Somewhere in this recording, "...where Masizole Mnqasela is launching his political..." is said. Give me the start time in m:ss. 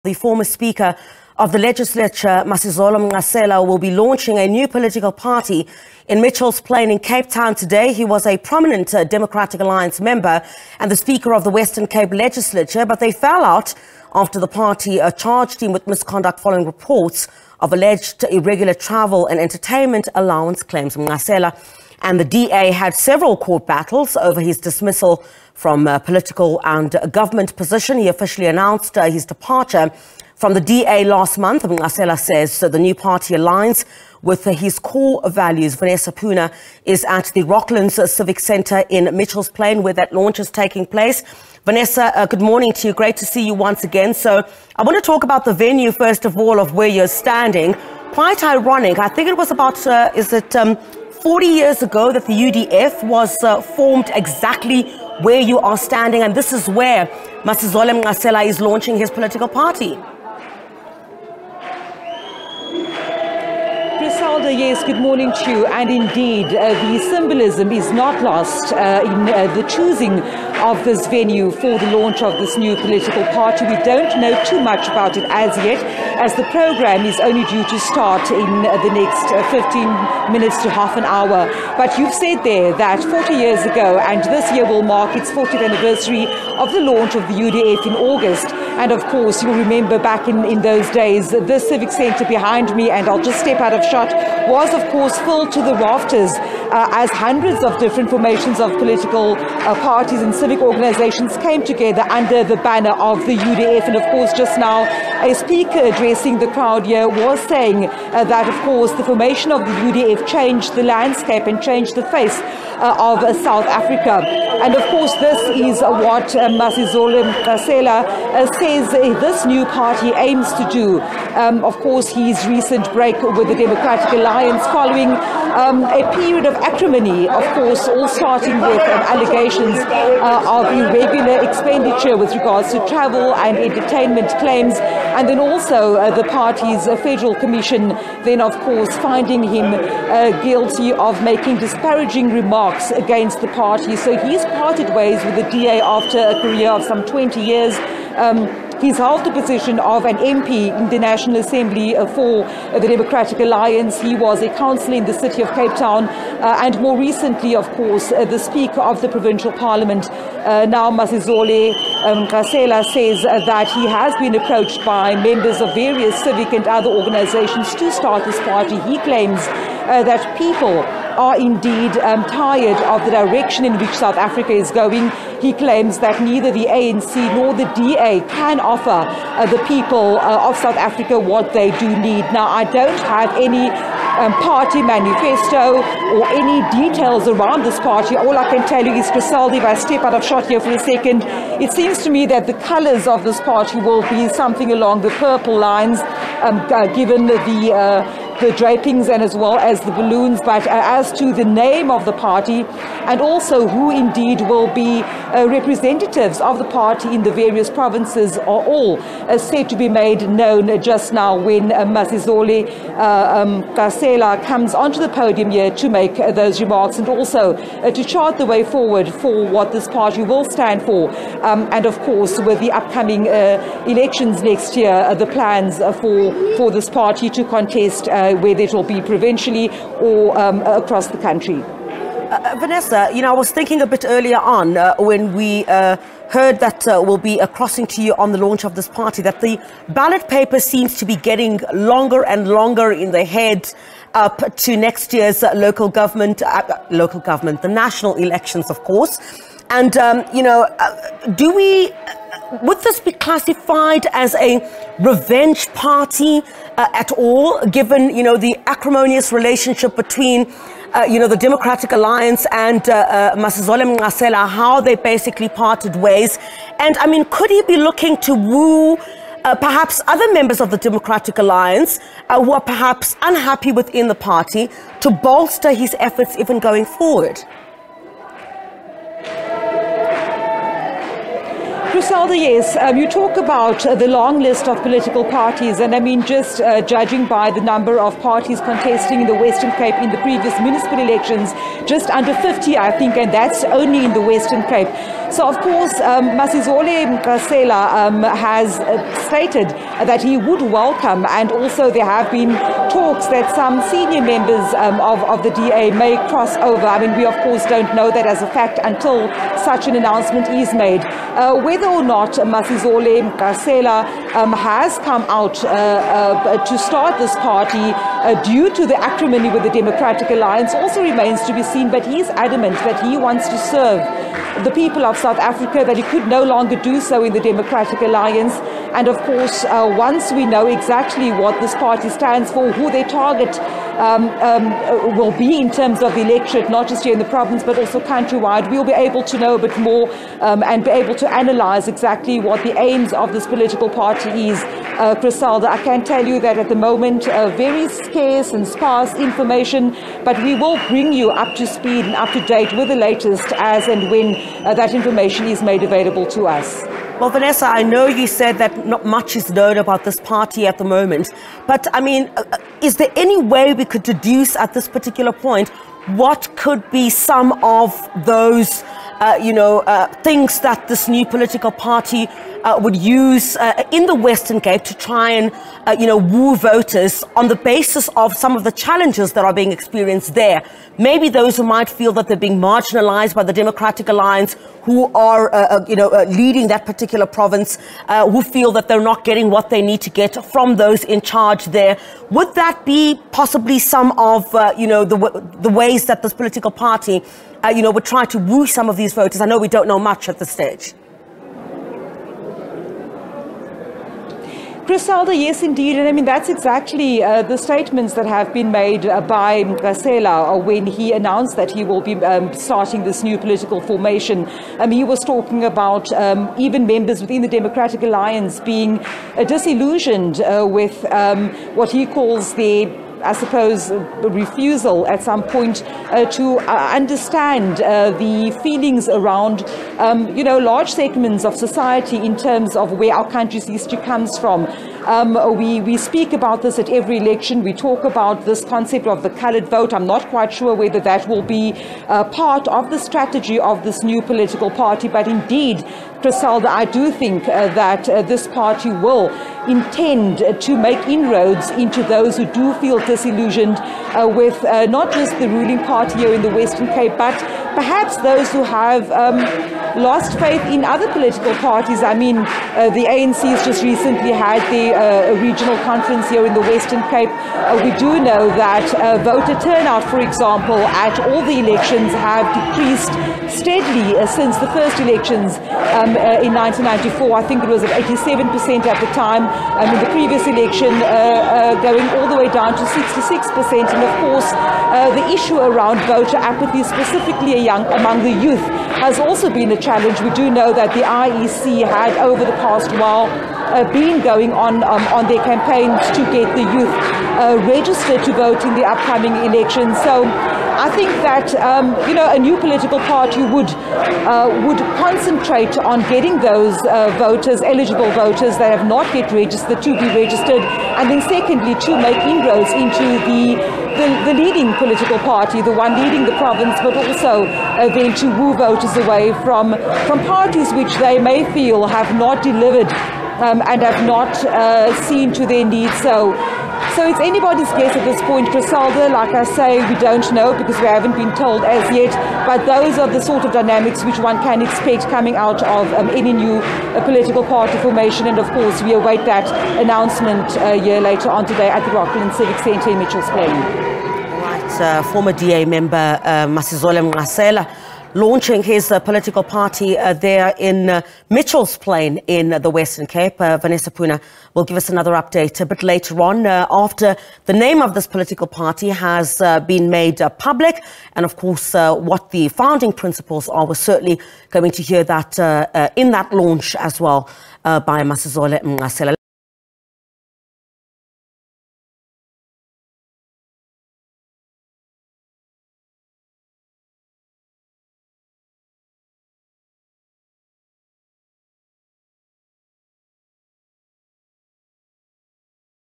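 0:56.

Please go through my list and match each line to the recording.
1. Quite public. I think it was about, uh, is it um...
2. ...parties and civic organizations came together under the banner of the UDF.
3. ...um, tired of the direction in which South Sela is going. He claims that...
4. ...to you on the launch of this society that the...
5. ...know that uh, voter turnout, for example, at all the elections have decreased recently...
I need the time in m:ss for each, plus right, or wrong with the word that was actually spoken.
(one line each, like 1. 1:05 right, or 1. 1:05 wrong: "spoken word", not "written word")
1. 0:48 wrong: "ironic", not "public"
2. 1:39 right
3. 2:51 wrong: "Africa", not "Sela"
4. 3:57 wrong: "party", not "society"
5. 7:48 wrong: "steadily", not "recently".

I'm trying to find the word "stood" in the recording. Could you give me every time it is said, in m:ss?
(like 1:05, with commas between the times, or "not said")
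not said.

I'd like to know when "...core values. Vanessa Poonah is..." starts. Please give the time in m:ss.
0:34.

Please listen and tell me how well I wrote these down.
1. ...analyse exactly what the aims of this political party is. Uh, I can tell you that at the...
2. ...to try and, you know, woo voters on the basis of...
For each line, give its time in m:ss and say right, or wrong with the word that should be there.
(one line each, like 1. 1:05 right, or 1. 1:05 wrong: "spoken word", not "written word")
1. 5:41 right
2. 6:14 right.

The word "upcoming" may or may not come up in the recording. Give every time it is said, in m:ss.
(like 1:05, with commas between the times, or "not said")
3:42, 8:18.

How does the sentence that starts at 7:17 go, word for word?
We talk about this concept of the colored vote.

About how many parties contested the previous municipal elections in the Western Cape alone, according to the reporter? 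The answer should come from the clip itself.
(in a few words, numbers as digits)
Just under 50.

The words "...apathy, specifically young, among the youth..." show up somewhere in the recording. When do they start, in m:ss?
8:06.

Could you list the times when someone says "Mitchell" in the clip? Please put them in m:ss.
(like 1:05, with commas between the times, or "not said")
0:06, 0:39, 9:02, 9:11.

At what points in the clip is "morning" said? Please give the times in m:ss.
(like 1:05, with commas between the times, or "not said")
0:42, 1:04.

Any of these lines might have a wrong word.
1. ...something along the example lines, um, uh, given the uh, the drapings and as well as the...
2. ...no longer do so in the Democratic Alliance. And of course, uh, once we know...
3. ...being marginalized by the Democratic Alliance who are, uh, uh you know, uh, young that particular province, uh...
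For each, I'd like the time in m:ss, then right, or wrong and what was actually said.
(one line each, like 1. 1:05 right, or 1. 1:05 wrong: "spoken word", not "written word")
1. 3:14 wrong: "purple", not "example"
2. 5:26 right
3. 6:22 wrong: "leading", not "young".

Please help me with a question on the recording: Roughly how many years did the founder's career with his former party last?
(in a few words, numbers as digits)
20 years.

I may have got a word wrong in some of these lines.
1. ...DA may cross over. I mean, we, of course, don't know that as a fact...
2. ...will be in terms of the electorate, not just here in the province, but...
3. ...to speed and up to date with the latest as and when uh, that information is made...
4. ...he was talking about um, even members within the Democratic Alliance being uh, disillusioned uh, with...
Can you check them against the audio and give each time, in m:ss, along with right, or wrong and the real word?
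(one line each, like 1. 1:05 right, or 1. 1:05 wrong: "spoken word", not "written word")
1. 5:05 right
2. 5:35 right
3. 5:51 right
4. 6:54 right.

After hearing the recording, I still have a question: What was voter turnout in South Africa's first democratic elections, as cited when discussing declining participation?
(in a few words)
87%.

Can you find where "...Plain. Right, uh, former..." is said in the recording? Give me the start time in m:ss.
9:03.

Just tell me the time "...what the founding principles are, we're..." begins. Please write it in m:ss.
9:21.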